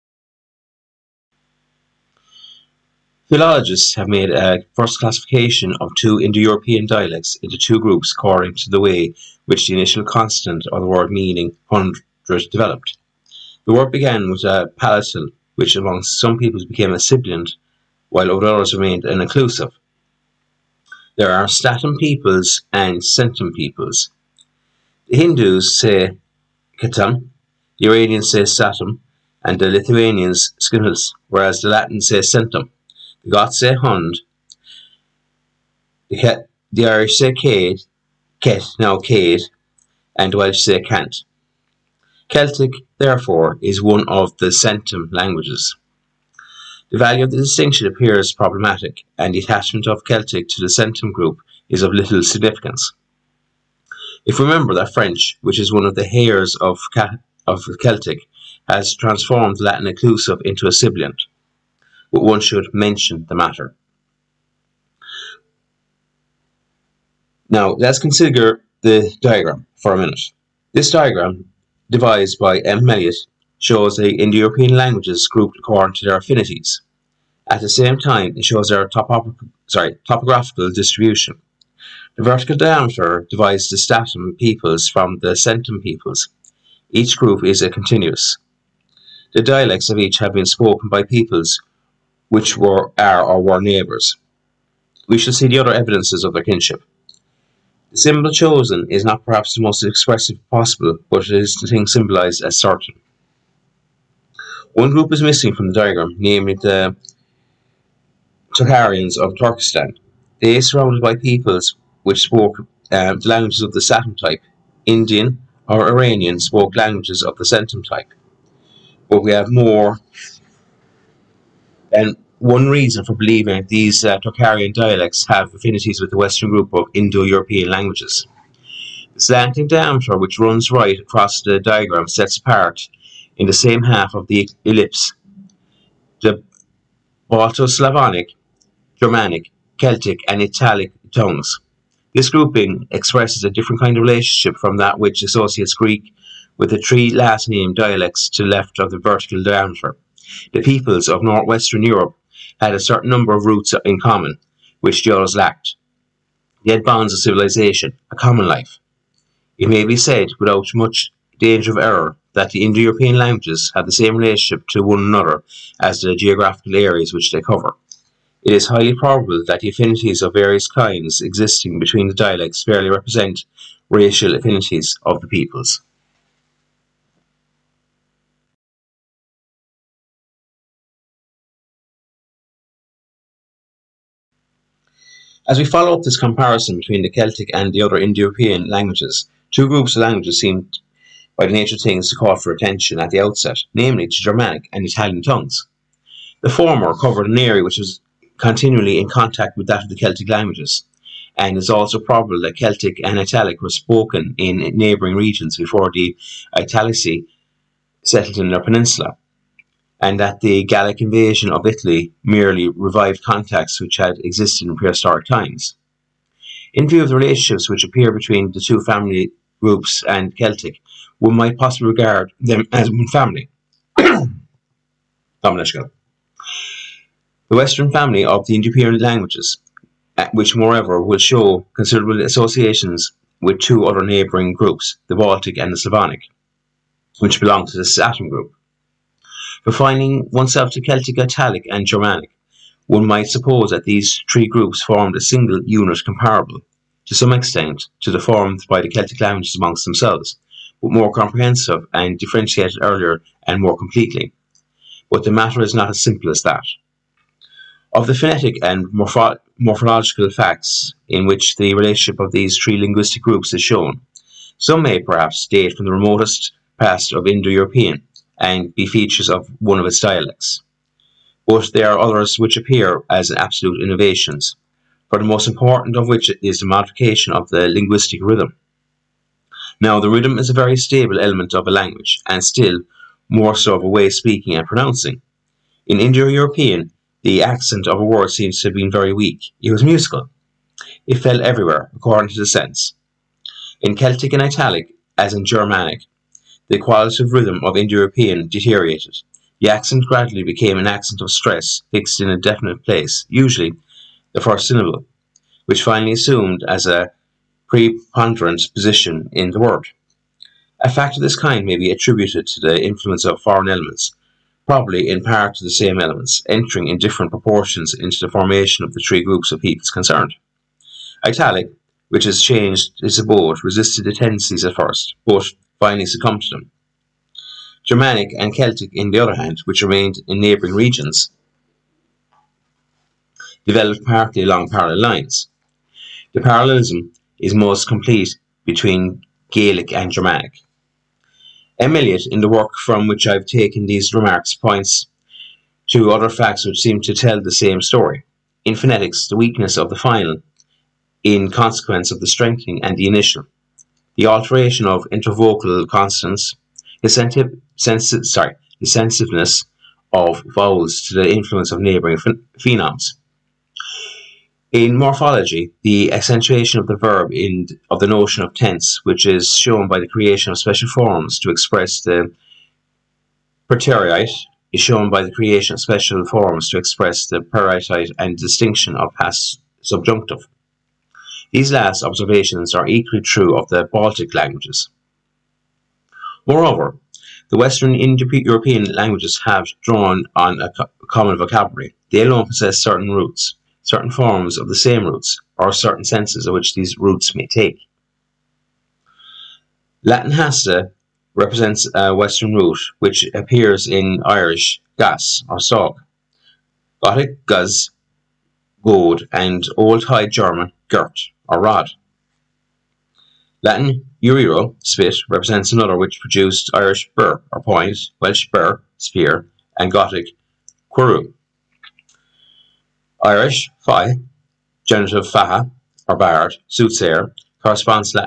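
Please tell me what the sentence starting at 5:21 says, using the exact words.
Italic, which has changed its abode, resisted the tendencies at first, but finally succumbed to them.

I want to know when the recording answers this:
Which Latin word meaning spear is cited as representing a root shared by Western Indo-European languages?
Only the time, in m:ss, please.
6:40.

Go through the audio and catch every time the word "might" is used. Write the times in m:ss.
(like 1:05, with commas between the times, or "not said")
3:41, 4:03.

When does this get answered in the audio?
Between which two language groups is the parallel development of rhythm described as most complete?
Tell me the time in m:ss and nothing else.
5:39.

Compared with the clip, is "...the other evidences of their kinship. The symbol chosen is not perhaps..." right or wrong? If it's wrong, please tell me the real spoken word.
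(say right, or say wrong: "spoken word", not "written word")
right.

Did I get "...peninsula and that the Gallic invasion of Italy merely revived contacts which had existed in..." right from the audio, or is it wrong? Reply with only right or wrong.
right.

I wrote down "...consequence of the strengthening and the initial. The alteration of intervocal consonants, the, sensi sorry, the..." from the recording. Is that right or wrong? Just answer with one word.
right.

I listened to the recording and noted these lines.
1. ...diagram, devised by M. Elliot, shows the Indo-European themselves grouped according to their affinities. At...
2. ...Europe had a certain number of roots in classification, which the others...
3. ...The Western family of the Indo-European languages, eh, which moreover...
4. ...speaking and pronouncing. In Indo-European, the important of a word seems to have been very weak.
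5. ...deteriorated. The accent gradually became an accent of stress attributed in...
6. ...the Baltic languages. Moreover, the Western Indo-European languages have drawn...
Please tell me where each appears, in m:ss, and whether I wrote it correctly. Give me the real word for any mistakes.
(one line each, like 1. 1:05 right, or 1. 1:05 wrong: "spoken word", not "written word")
1. 1:10 wrong: "languages", not "themselves"
2. 2:31 wrong: "common", not "classification"
3. 3:44 right
4. 4:44 wrong: "accent", not "important"
5. 4:58 wrong: "fixed", not "attributed"
6. 6:23 right.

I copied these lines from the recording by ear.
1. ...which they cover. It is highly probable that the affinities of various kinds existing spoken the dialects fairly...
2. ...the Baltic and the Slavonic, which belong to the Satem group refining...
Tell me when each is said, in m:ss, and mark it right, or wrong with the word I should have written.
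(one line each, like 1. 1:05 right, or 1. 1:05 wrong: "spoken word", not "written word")
1. 2:47 wrong: "between", not "spoken"
2. 3:55 right.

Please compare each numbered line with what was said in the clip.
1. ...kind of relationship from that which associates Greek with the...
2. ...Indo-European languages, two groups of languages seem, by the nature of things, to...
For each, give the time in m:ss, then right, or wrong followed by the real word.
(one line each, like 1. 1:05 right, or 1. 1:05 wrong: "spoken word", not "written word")
1. 2:23 right
2. 3:07 right.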